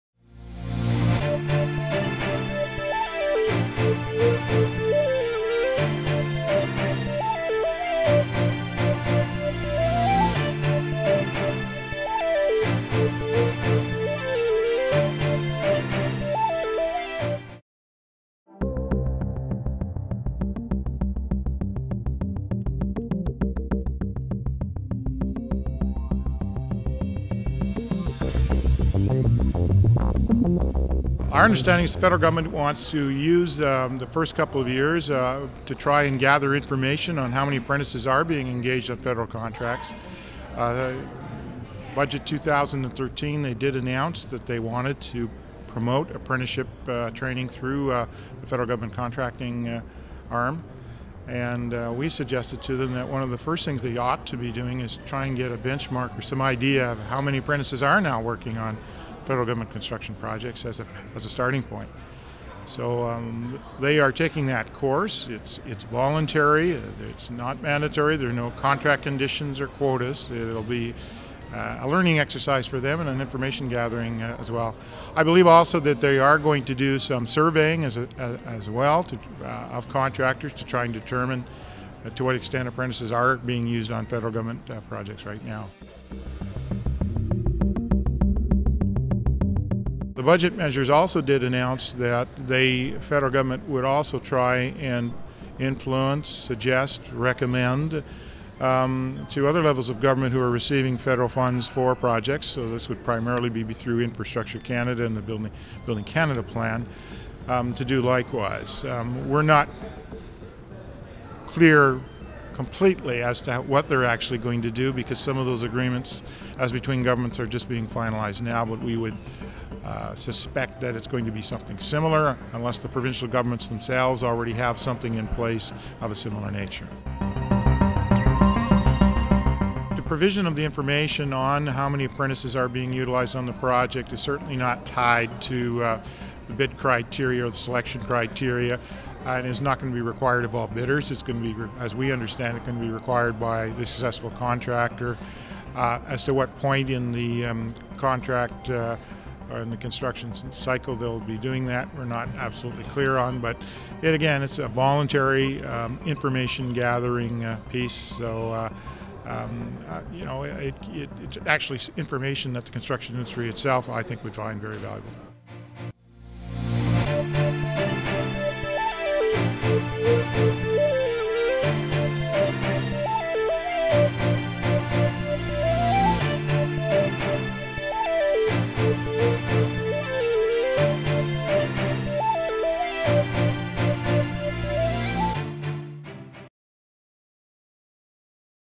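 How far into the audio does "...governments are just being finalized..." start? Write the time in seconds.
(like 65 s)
117 s.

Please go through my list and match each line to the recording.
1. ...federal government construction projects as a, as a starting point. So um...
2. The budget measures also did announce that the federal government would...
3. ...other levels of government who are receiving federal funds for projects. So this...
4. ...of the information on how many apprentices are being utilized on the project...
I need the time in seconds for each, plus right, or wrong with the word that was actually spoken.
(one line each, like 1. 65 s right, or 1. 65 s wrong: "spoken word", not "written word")
1. 59 s right
2. 90 s right
3. 99 s right
4. 130 s right.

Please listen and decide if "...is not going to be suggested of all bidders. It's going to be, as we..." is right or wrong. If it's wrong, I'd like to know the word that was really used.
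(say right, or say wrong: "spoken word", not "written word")
wrong: "required", not "suggested".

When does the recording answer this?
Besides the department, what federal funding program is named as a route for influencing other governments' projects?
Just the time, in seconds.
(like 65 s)
105 s.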